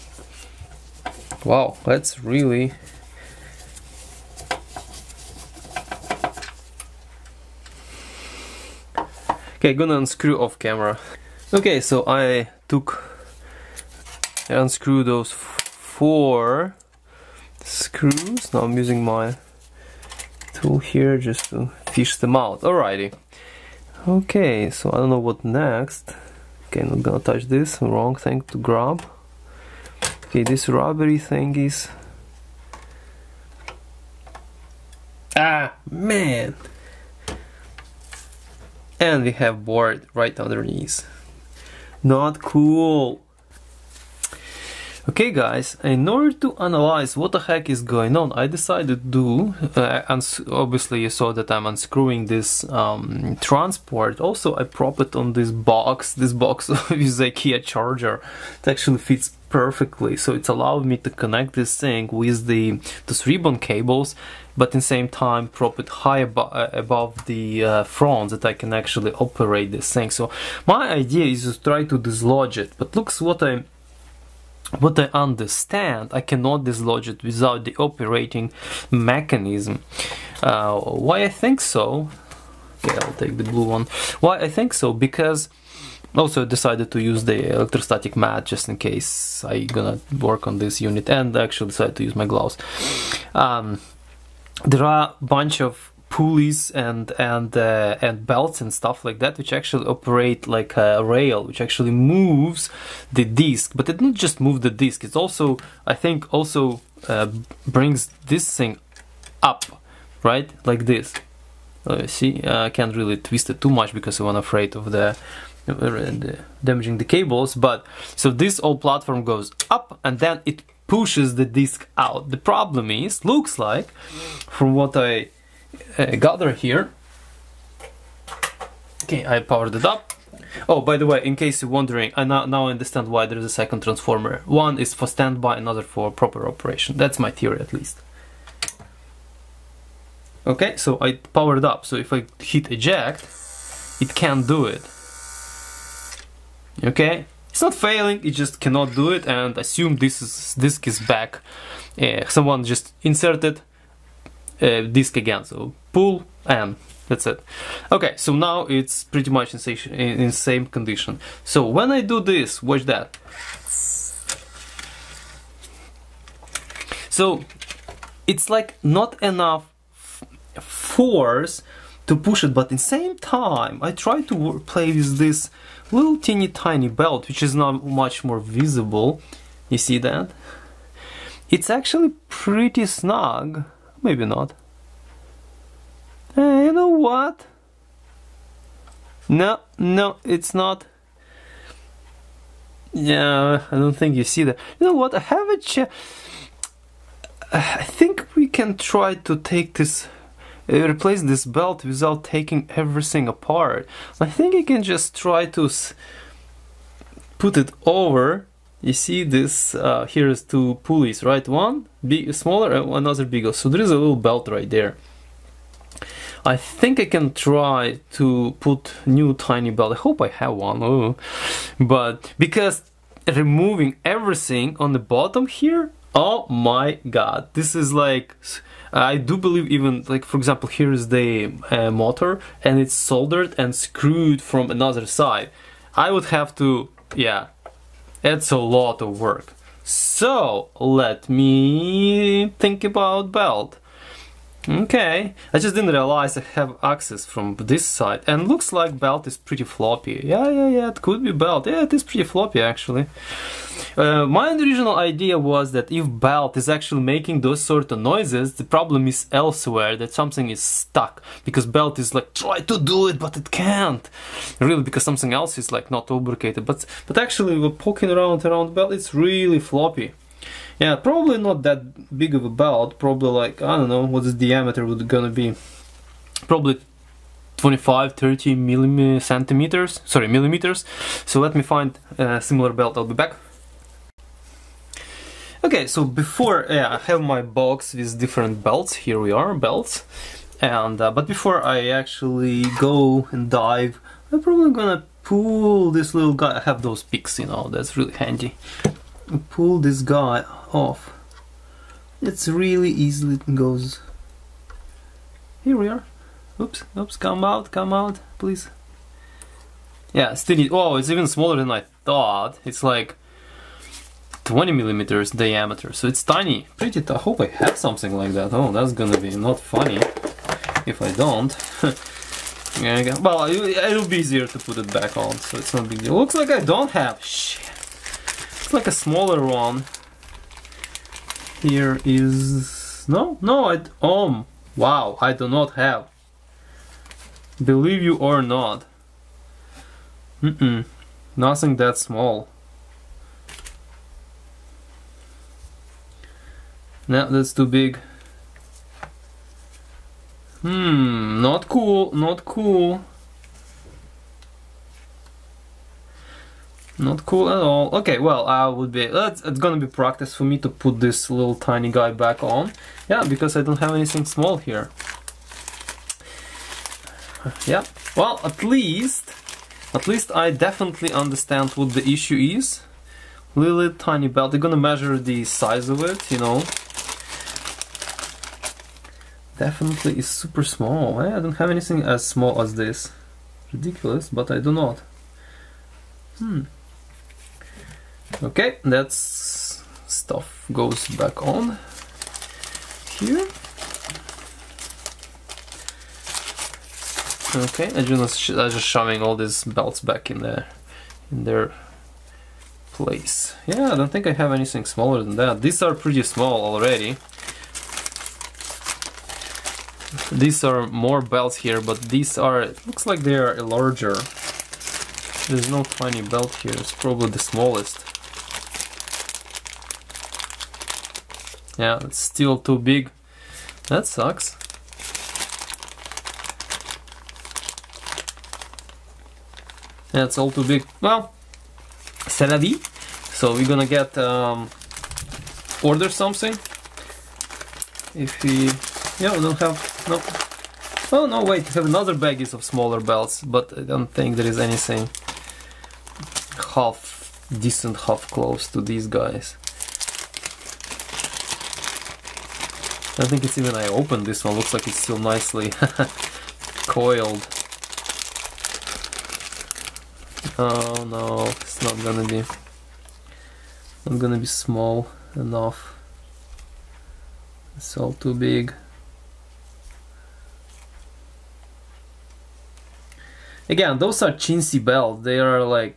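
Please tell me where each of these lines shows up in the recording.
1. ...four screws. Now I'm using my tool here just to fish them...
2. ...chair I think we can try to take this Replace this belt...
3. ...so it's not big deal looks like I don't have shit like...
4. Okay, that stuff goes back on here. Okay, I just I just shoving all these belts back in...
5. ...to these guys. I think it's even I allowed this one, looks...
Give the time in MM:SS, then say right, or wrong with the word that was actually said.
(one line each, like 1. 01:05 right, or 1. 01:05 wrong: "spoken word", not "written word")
1. 00:15 right
2. 03:15 right
3. 05:25 right
4. 06:28 right
5. 07:28 wrong: "opened", not "allowed".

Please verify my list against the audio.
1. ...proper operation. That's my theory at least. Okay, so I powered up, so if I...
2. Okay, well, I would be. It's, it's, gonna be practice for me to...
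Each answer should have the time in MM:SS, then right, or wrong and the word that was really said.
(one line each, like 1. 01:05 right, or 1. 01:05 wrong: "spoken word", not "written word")
1. 02:16 right
2. 05:57 right.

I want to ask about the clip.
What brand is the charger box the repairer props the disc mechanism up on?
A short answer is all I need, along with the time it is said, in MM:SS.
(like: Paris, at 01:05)
IKEA, at 00:56.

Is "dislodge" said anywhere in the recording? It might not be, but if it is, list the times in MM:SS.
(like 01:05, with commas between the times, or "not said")
01:11, 01:16.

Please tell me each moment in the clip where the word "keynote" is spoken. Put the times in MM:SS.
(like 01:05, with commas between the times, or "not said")
not said.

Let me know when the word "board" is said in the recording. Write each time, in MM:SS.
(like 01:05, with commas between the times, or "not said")
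00:39.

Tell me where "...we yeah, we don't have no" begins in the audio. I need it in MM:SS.
07:18.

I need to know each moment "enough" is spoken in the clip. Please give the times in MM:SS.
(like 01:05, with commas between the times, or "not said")
02:49, 07:45.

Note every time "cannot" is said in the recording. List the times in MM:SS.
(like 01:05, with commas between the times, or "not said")
01:16, 02:28.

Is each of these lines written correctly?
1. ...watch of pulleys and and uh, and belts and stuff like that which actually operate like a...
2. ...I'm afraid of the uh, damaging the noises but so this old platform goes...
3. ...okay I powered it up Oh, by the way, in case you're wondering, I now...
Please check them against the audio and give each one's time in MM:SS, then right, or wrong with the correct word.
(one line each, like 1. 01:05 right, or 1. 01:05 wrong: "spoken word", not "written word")
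1. 01:35 wrong: "bunch", not "watch"
2. 01:54 wrong: "cables", not "noises"
3. 02:09 right.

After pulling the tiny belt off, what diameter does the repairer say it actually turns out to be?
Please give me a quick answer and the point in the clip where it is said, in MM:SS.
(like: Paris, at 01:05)
20 millimeters, at 05:14.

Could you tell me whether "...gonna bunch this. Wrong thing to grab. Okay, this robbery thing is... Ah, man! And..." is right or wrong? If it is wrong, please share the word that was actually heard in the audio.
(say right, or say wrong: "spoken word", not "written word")
wrong: "touch", not "bunch".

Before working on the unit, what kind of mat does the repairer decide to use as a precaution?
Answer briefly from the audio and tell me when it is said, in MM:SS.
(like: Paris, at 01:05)
electrostatic mat, at 01:27.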